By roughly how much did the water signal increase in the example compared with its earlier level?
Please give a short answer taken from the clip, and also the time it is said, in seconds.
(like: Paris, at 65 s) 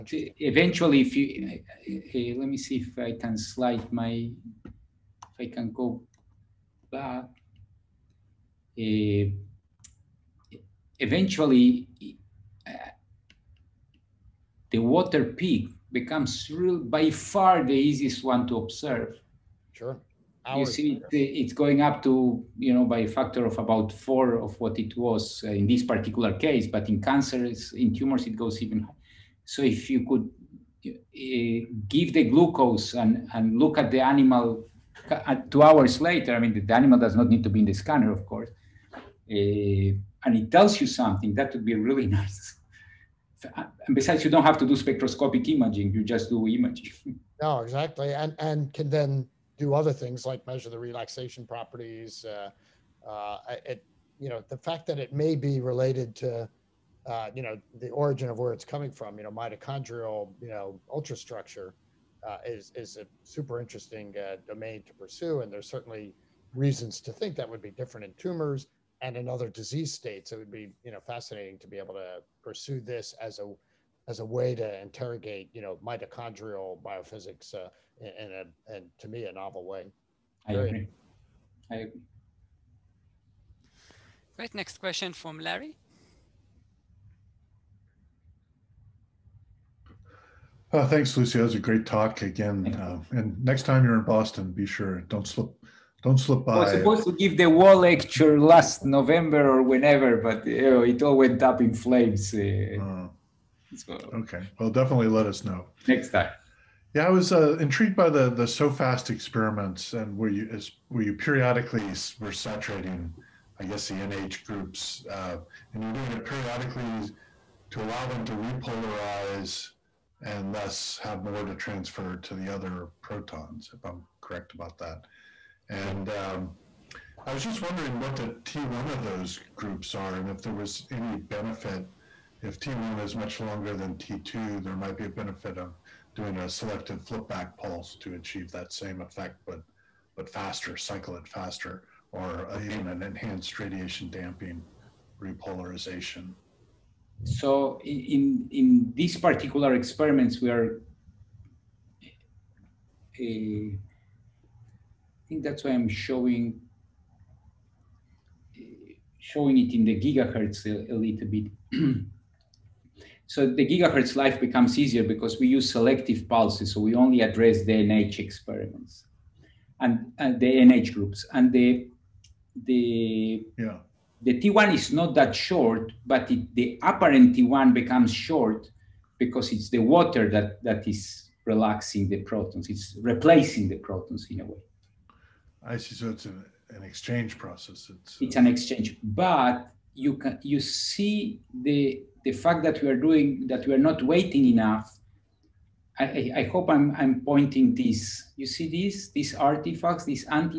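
factor of 4, at 22 s.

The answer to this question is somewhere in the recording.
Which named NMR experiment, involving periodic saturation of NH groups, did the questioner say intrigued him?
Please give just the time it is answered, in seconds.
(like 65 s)
108 s.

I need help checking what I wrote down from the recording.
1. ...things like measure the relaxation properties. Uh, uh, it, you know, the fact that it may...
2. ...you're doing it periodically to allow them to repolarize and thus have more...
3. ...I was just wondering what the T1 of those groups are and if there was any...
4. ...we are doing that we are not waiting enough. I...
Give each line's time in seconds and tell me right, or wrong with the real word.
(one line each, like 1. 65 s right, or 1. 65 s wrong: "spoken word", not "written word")
1. 49 s right
2. 115 s right
3. 127 s right
4. 192 s right.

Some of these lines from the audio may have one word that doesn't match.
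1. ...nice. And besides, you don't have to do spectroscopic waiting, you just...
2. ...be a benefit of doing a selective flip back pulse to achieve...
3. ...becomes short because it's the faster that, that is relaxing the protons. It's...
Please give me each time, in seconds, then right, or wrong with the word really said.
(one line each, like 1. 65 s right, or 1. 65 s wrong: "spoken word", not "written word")
1. 42 s wrong: "imaging", not "waiting"
2. 134 s right
3. 177 s wrong: "water", not "faster".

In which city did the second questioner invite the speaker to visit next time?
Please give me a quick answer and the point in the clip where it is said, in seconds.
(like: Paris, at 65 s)
Boston, at 94 s.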